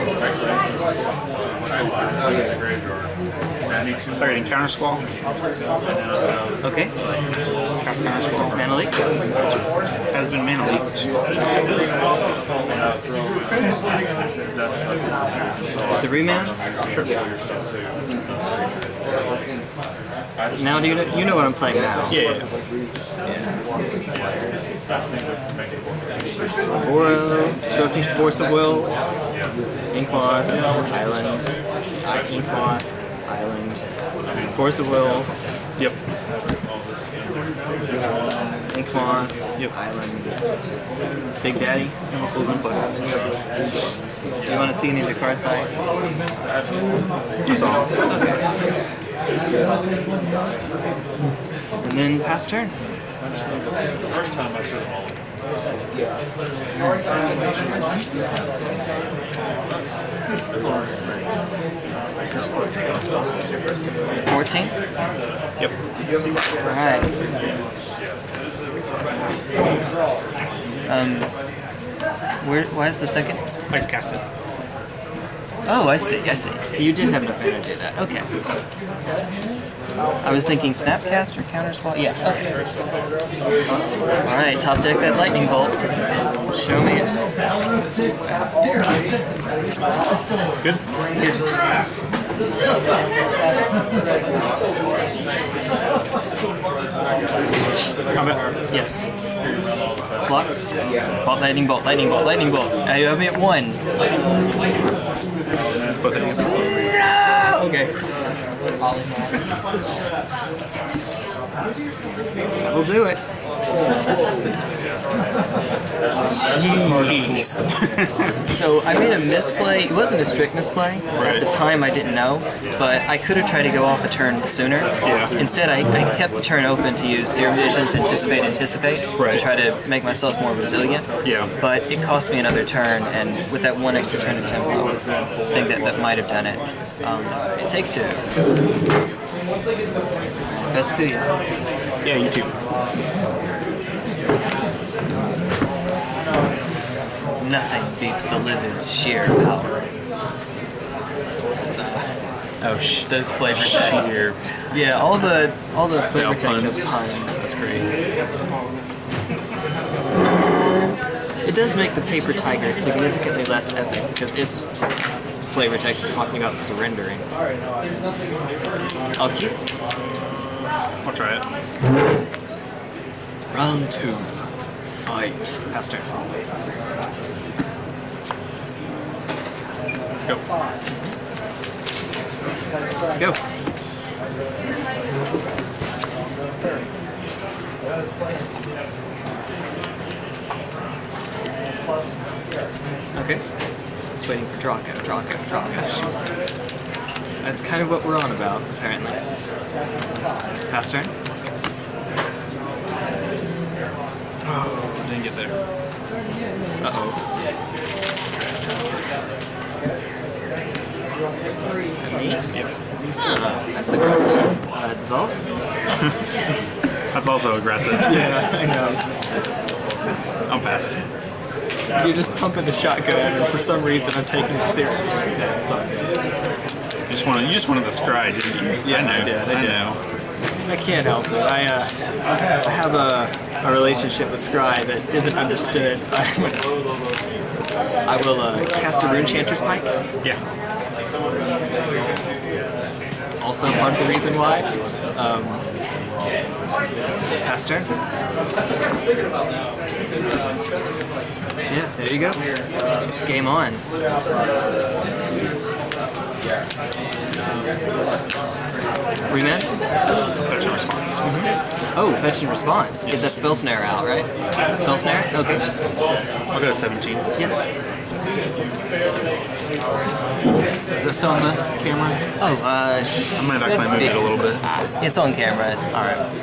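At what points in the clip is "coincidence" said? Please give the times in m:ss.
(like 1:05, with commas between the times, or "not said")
not said.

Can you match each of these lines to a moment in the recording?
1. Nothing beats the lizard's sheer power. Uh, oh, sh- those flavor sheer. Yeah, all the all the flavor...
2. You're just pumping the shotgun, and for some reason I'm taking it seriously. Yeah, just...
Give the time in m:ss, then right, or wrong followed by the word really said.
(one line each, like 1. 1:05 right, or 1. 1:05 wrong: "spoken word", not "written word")
1. 2:27 right
2. 3:42 right.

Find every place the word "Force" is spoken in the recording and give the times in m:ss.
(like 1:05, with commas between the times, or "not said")
0:28, 0:34.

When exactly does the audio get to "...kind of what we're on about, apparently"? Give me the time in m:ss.
3:17.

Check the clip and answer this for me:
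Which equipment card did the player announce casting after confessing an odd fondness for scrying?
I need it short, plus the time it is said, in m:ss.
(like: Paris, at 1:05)
Runechanter's Pike, at 3:59.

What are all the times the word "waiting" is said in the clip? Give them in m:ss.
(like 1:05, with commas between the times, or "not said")
3:14.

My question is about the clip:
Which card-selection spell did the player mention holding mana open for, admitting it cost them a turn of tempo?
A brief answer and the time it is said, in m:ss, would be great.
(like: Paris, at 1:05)
Serum Visions, at 2:07.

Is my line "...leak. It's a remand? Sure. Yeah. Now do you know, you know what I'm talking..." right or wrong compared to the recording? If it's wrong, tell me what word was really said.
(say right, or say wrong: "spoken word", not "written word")
wrong: "playing", not "talking".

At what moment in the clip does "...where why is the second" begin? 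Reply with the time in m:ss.
1:12.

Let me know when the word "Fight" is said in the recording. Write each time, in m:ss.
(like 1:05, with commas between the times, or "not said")
2:55.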